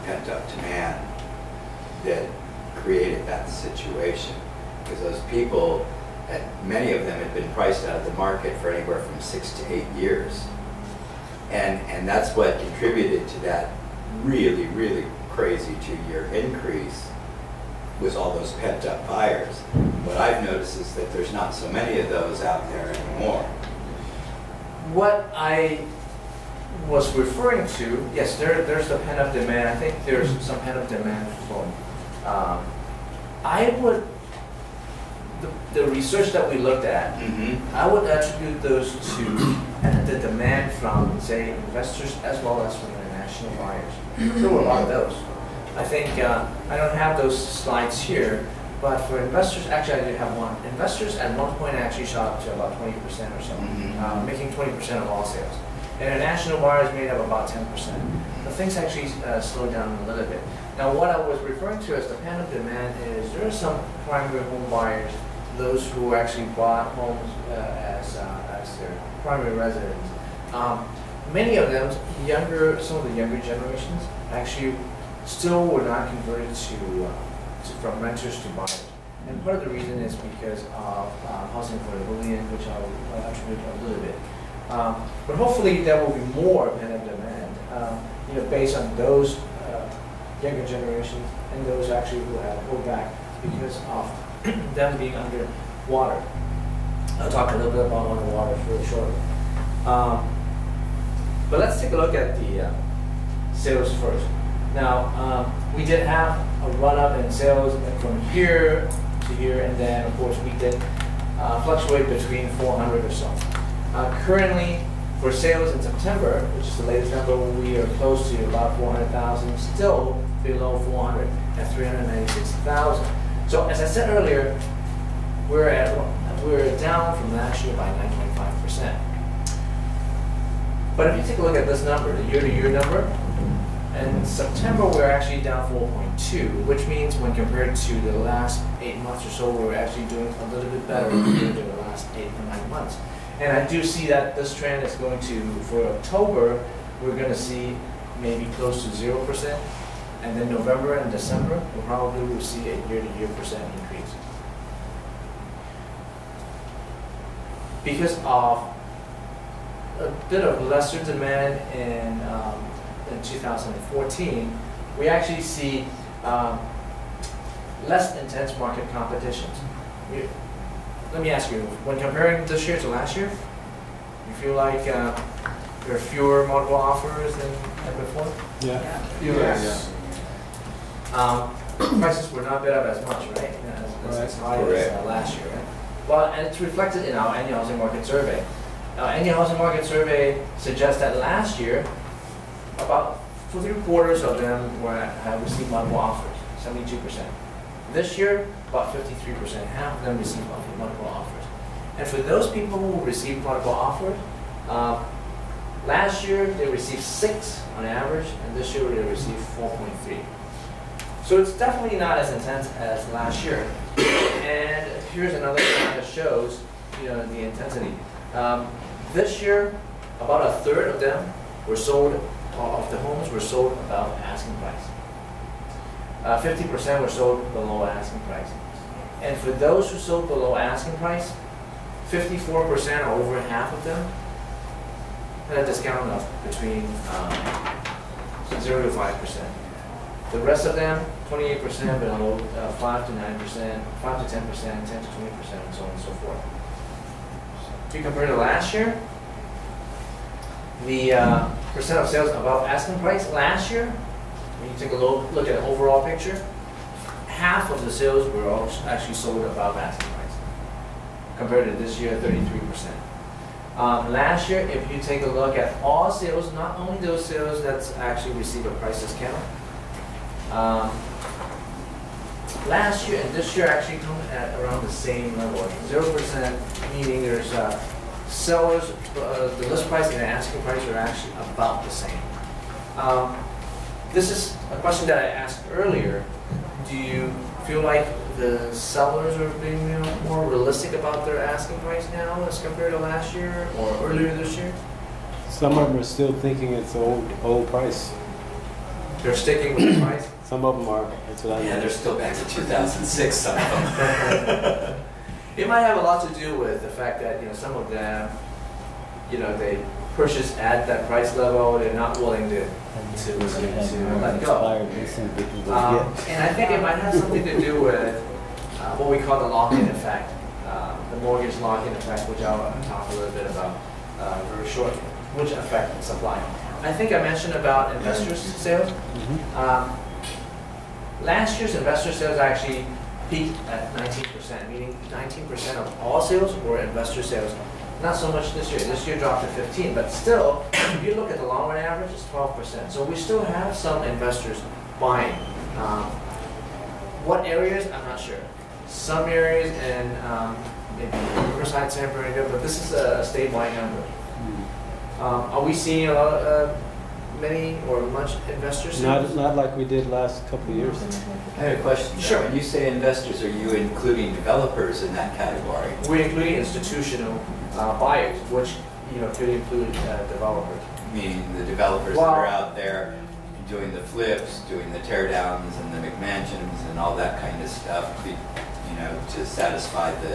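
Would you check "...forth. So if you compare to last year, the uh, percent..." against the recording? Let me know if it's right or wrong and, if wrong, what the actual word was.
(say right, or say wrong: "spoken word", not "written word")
right.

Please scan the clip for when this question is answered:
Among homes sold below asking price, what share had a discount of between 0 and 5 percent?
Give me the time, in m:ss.
3:52.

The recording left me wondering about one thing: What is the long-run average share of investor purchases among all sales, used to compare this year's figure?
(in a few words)
12%.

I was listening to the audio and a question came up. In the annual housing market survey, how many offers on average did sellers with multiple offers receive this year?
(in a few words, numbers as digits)
4.3.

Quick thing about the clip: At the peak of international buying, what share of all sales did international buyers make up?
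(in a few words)
10%.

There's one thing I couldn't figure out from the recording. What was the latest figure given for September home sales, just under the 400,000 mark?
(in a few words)
396,000.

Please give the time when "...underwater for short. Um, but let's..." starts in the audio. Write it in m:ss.
1:38.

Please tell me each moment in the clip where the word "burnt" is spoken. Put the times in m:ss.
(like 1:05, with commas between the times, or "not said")
not said.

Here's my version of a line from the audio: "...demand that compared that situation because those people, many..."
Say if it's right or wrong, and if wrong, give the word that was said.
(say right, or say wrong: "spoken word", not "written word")
wrong: "created", not "compared".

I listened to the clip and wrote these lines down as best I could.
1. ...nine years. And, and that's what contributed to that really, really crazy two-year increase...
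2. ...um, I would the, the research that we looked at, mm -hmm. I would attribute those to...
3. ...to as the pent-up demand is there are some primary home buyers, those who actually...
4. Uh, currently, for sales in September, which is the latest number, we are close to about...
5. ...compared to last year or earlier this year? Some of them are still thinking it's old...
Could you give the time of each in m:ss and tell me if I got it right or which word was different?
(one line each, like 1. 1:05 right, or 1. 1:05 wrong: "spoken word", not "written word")
1. 0:09 wrong: "eight", not "nine"
2. 0:32 right
3. 1:01 right
4. 1:53 right
5. 4:52 right.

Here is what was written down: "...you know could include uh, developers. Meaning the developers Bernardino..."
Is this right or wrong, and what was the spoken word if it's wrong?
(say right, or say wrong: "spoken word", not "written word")
wrong: "Well", not "Bernardino".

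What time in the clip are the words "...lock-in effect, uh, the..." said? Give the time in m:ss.
5:19.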